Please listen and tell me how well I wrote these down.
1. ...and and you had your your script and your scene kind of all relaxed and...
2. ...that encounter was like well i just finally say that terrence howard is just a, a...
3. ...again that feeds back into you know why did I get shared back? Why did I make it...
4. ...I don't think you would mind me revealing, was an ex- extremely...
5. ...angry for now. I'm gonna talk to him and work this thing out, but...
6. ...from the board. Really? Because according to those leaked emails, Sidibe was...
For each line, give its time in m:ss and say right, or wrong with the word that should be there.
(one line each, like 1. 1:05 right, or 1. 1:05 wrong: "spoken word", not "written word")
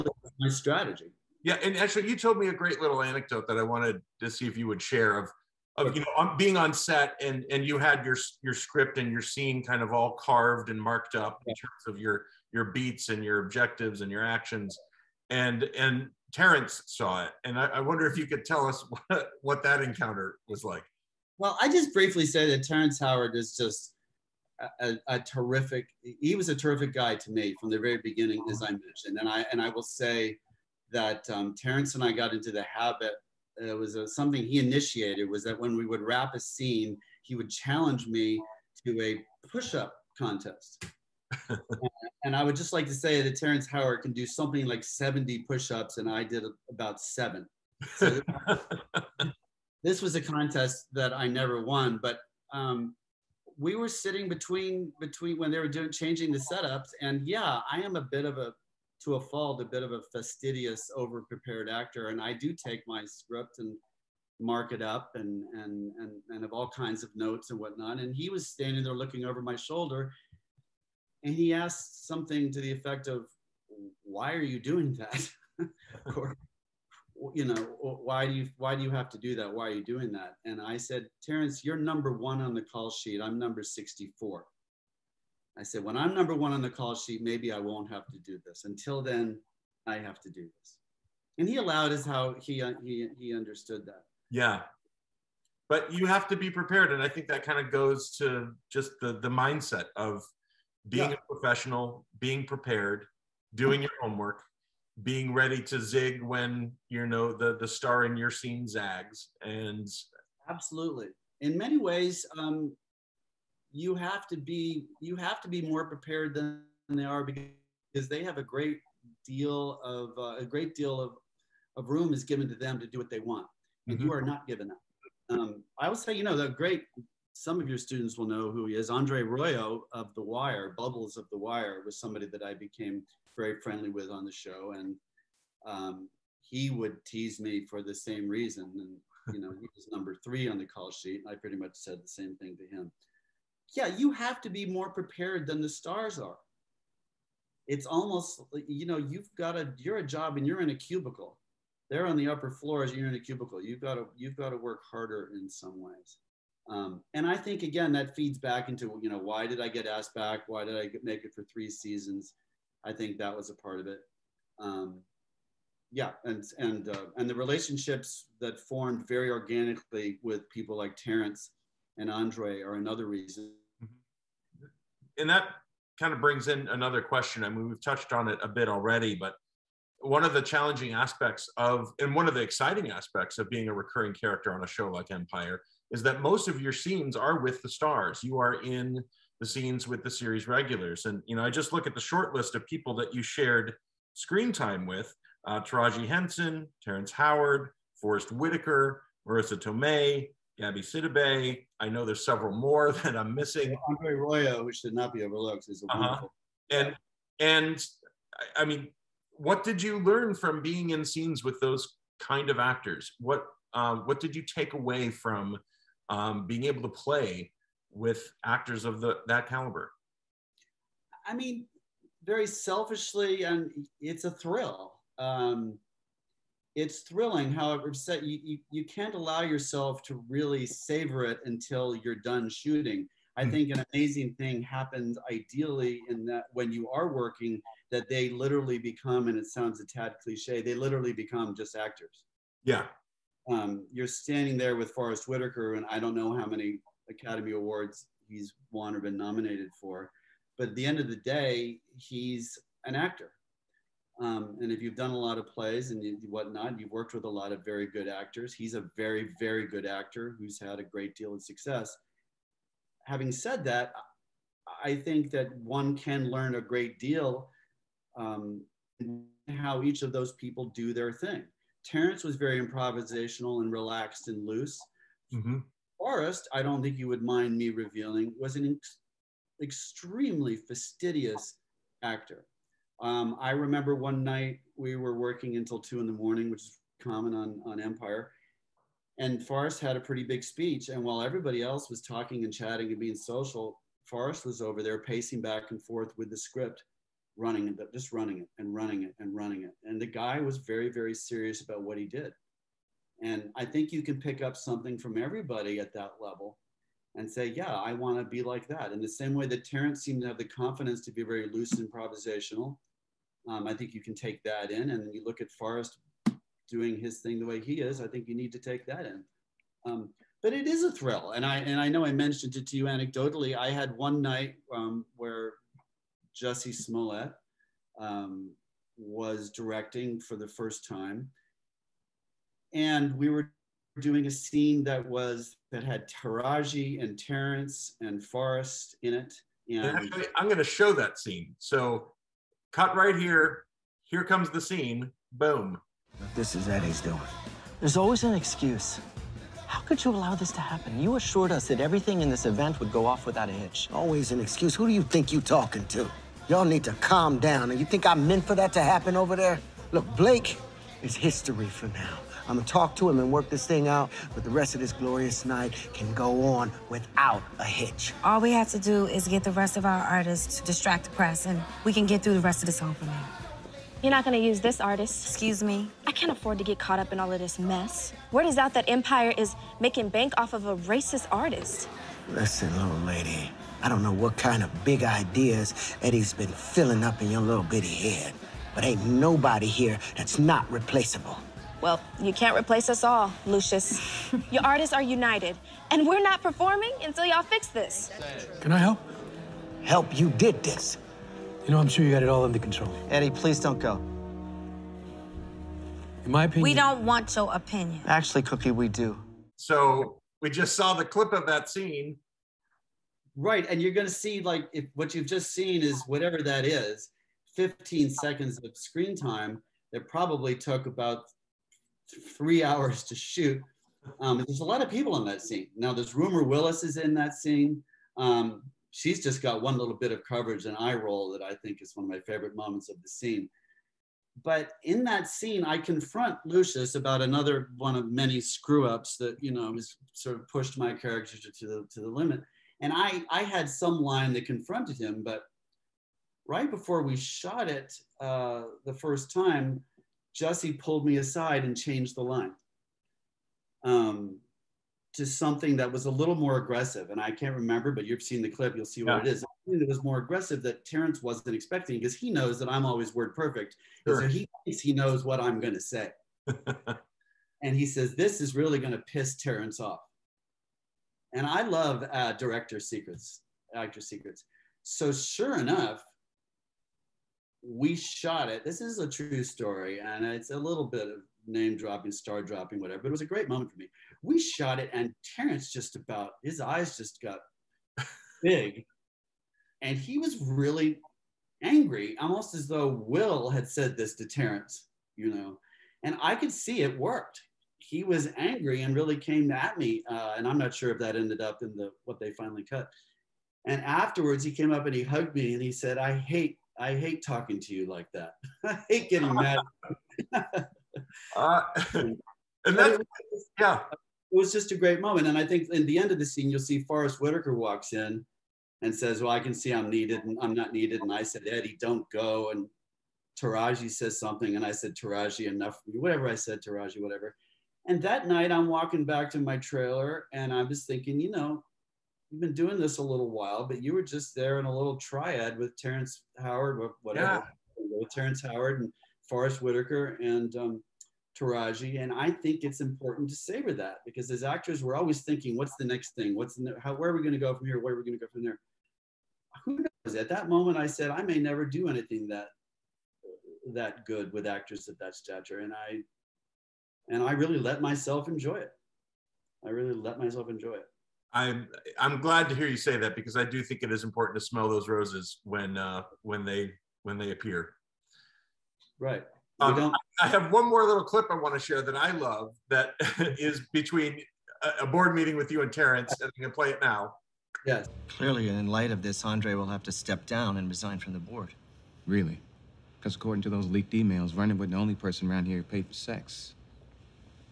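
1. 0:07 wrong: "carved", not "relaxed"
2. 0:19 wrong: "briefly", not "finally"
3. 2:37 wrong: "asked", not "shared"
4. 4:36 right
5. 6:01 wrong: "history", not "angry"
6. 9:40 wrong: "Vernon", not "Sidibe".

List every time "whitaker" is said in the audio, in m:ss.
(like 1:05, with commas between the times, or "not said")
3:18, 4:05, 8:37, 8:59.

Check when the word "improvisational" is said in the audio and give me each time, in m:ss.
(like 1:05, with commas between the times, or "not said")
4:32, 5:11.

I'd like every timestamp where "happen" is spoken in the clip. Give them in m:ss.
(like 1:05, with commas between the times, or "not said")
3:54, 5:50, 5:58.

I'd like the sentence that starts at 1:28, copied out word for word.
Until then, I have to do this.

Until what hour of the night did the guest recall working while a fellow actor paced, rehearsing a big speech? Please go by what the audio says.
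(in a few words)
2 in the morning.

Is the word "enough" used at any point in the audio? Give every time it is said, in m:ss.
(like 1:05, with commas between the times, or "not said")
7:55, 8:45.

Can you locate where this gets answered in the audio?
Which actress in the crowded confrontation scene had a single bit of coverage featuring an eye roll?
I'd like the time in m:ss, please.
7:06.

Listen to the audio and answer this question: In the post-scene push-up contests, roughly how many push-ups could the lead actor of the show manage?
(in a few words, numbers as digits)
70.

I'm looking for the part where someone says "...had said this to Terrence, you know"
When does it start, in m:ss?
8:13.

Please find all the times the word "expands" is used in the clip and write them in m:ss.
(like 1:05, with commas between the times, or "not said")
not said.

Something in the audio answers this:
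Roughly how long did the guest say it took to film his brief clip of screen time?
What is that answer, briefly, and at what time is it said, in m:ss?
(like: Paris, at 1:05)
3 hours, at 7:02.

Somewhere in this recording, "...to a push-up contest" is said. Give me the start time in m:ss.
0:38.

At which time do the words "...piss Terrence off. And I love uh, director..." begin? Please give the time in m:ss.
7:48.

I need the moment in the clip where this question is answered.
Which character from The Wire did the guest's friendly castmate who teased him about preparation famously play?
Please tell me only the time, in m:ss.
2:10.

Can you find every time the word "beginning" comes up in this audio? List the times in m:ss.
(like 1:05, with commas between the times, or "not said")
0:27.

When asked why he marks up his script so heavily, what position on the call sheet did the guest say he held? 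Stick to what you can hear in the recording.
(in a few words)
64.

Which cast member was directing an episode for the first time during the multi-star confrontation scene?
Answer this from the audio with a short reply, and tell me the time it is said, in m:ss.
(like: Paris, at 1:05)
Jussie Smollett, at 5:26.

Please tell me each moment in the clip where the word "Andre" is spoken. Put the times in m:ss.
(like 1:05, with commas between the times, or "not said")
2:08, 2:52, 3:23, 9:39.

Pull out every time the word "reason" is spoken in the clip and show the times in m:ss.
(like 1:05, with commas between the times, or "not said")
2:18, 2:53.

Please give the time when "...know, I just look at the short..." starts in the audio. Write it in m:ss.
3:11.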